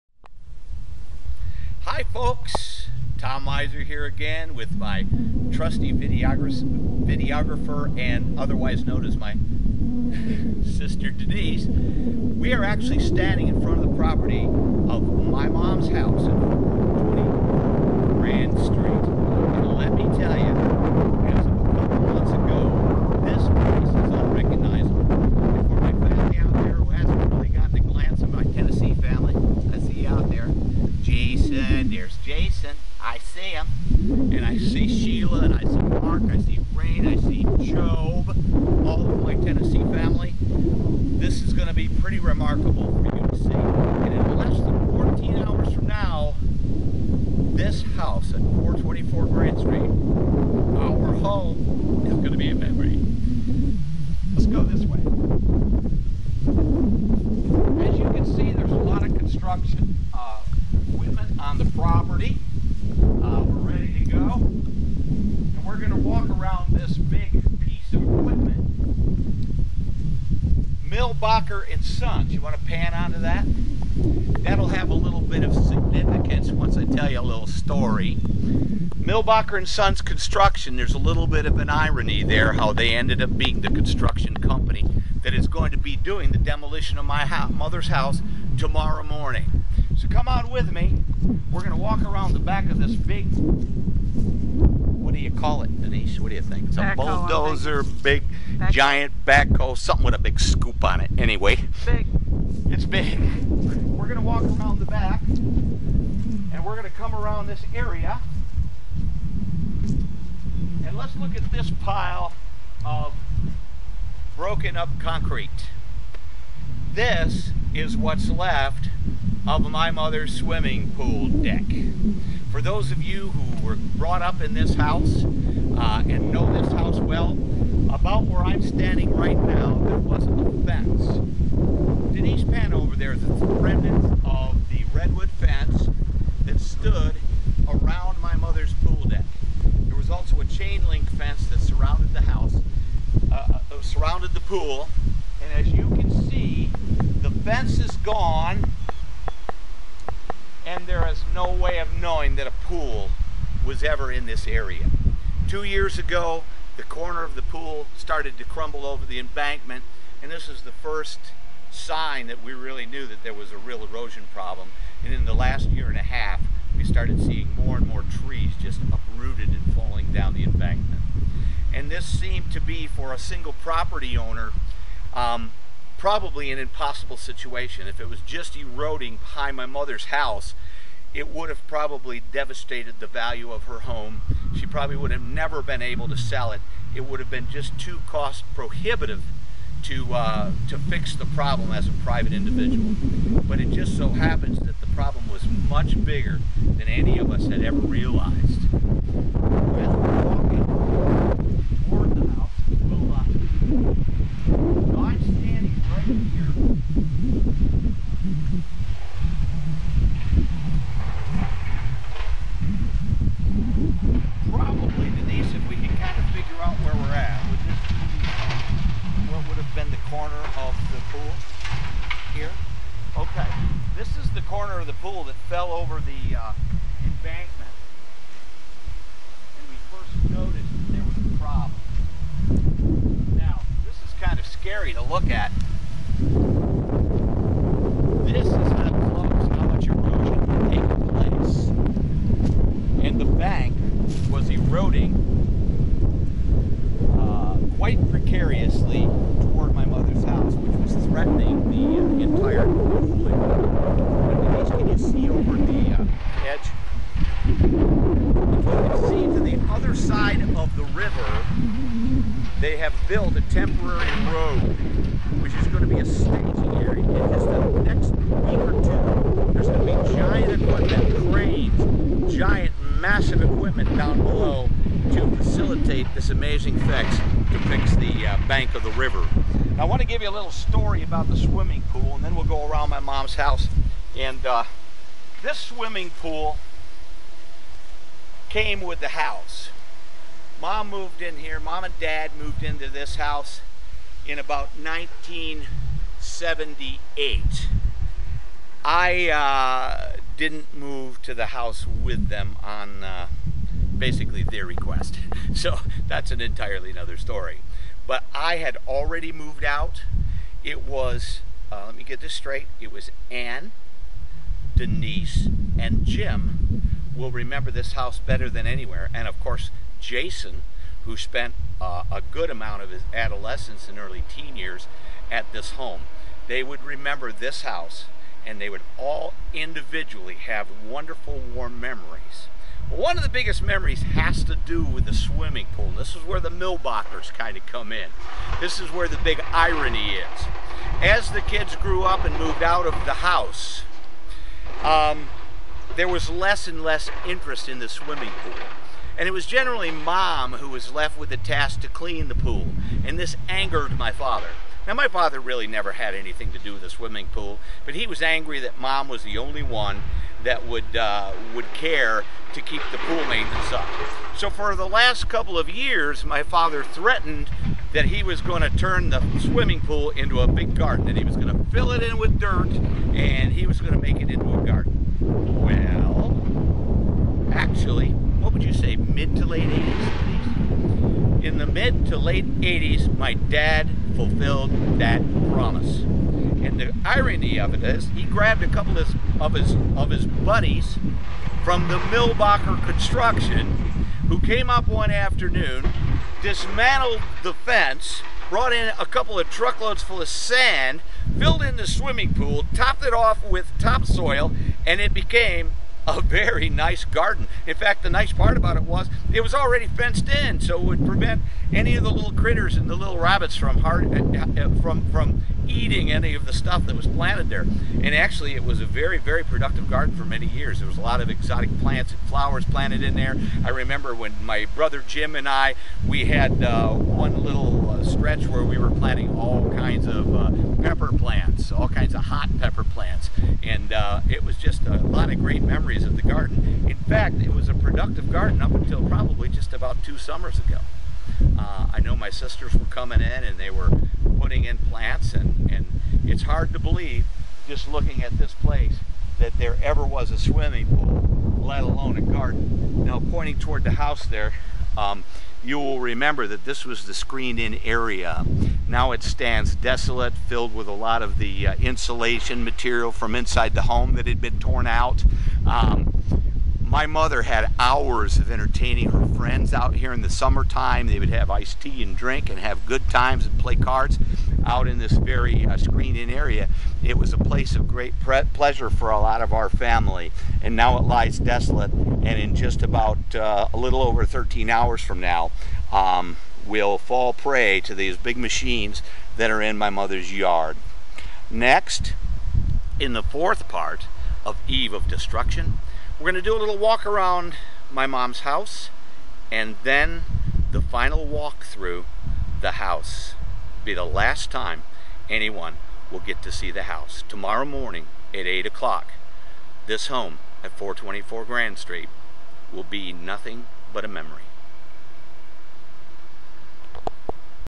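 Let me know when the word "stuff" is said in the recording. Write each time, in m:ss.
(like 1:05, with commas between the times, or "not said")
6:56.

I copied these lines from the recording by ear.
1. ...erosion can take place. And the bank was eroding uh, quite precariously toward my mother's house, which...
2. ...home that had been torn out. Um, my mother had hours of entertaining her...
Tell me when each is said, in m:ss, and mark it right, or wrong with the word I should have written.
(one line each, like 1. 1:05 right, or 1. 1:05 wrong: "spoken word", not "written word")
1. 3:59 right
2. 7:43 right.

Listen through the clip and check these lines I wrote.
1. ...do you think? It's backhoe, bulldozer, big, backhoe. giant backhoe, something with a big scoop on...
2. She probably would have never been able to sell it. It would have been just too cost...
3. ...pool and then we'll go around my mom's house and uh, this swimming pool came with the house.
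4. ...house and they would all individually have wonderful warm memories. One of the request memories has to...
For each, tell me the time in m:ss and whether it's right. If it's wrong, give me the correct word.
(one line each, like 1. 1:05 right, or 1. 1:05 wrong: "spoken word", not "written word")
1. 1:36 right
2. 3:04 right
3. 4:41 right
4. 5:27 wrong: "biggest", not "request".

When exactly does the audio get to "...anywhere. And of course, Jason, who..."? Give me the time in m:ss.
5:18.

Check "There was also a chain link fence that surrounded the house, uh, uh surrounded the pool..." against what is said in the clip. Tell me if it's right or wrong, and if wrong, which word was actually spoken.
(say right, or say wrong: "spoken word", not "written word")
right.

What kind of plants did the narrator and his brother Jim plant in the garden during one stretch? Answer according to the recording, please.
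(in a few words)
hot pepper plants.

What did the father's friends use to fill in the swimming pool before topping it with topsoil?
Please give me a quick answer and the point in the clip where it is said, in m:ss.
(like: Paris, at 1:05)
sand, at 6:40.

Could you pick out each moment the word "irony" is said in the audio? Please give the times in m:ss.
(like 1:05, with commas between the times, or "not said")
1:21, 5:39, 6:27.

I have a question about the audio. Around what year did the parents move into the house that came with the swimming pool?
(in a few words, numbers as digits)
1978.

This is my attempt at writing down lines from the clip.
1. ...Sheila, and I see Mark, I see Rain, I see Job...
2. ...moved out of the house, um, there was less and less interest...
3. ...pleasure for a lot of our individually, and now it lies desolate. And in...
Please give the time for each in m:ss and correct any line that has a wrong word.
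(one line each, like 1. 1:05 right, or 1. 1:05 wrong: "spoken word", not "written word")
1. 0:34 right
2. 5:42 right
3. 7:58 wrong: "family", not "individually".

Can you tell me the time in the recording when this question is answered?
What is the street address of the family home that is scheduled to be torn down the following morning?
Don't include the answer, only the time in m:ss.
0:48.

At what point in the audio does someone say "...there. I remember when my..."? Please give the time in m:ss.
7:03.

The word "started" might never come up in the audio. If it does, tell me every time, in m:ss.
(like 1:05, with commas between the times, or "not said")
2:37, 2:46.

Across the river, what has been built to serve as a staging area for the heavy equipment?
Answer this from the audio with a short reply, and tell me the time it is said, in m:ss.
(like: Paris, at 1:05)
temporary road, at 4:23.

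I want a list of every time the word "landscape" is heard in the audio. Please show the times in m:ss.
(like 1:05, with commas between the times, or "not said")
not said.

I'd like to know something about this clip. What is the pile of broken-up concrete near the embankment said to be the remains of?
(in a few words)
swimming pool deck.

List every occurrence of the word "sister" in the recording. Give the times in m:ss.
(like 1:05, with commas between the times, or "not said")
0:10, 7:22.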